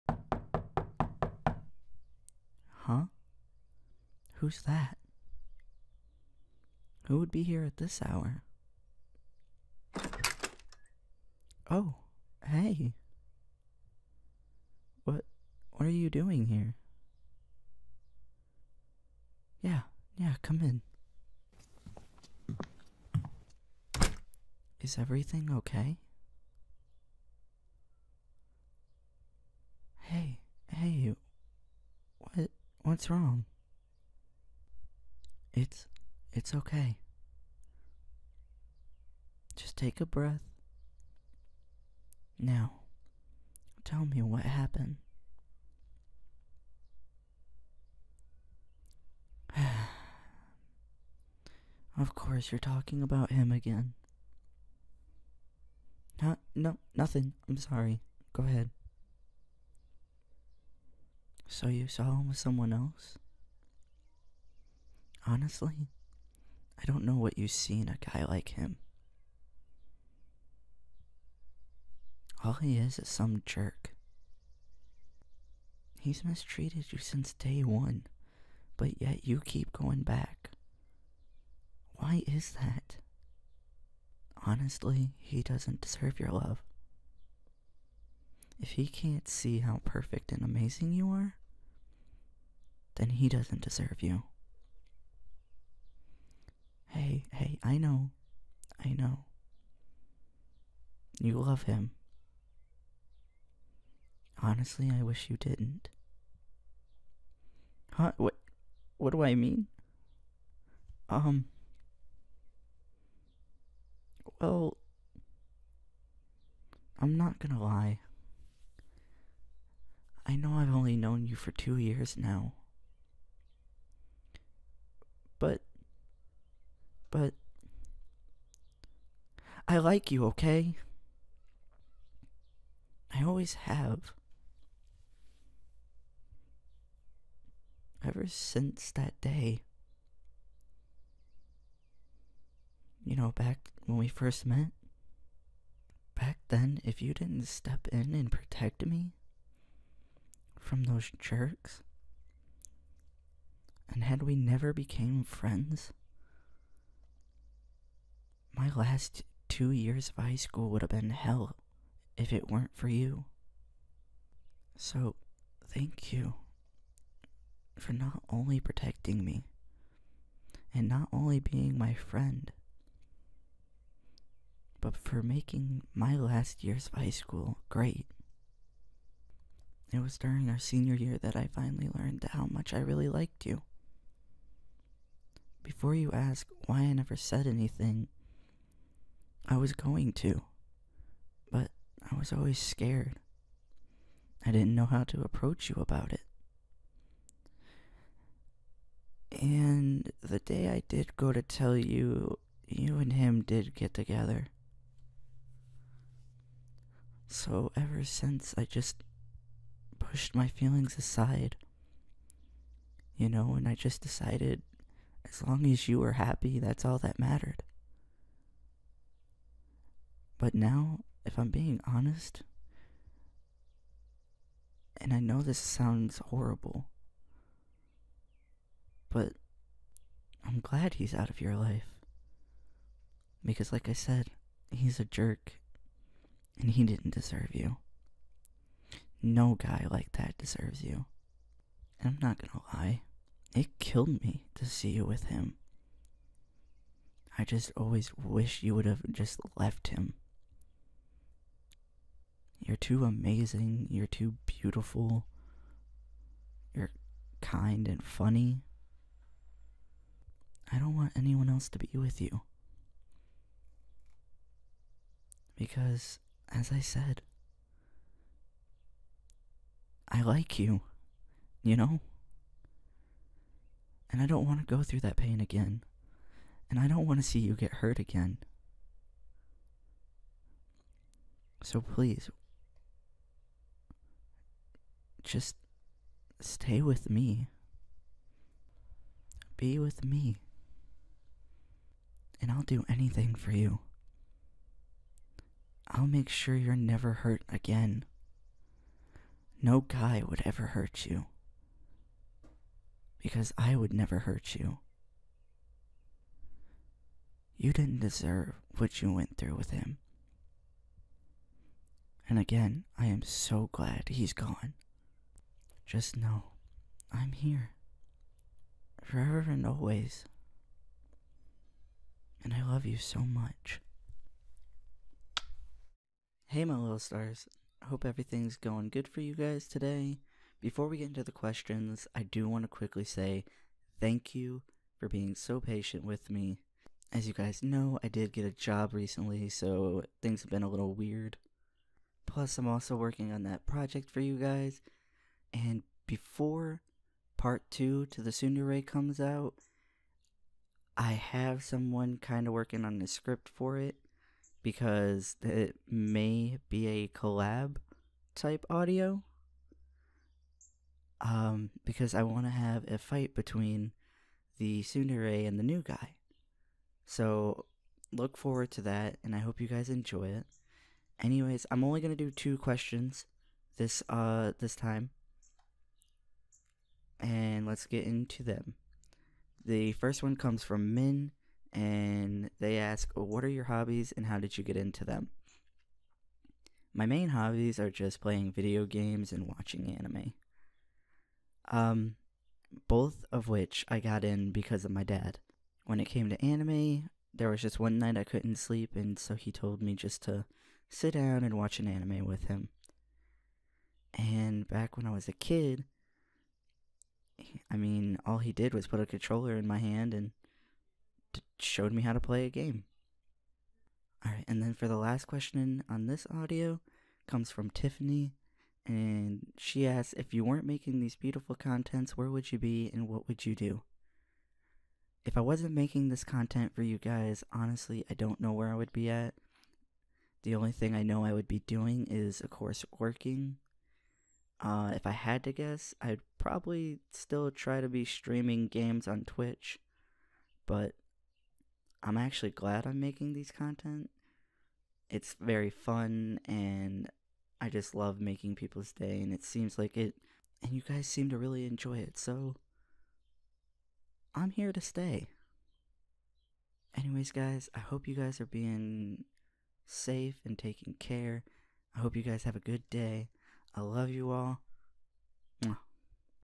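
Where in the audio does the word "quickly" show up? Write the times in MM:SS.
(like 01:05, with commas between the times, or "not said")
05:32.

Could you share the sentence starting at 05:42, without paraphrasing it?
Plus, I'm also working on that project for you guys.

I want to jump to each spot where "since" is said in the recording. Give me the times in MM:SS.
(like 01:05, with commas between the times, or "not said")
01:16, 02:18, 03:28.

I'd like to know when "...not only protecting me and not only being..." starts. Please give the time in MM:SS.
02:47.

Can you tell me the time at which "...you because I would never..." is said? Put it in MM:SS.
05:01.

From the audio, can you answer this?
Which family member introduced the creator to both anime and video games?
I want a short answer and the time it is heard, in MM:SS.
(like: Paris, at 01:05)
Dad, at 06:35.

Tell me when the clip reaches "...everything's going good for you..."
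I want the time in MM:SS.
05:28.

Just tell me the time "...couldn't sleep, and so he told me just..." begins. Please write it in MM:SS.
06:38.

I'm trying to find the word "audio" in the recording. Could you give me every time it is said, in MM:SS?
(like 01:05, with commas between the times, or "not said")
05:58, 06:56.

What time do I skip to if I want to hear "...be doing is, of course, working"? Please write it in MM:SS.
07:11.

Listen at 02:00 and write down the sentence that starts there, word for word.
I know I've only known you for two years now.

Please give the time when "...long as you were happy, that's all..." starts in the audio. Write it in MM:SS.
03:35.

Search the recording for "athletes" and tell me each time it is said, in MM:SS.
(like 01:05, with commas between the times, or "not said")
not said.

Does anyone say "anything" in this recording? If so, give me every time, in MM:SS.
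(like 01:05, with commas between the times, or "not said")
03:07, 04:52.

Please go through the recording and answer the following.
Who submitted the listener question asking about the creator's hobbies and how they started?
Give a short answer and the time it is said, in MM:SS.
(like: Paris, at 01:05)
Min, at 06:20.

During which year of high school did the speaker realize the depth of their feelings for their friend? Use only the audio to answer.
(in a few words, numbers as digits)
Senior year.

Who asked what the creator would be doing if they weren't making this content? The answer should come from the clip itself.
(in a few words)
Tiffany.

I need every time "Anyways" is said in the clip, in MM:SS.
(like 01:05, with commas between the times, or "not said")
06:11, 07:36.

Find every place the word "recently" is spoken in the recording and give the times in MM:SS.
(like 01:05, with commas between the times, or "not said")
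05:38.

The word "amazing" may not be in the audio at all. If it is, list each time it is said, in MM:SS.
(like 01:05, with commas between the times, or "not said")
01:30, 04:13.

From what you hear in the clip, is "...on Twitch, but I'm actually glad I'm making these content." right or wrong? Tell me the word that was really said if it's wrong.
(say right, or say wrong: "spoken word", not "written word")
right.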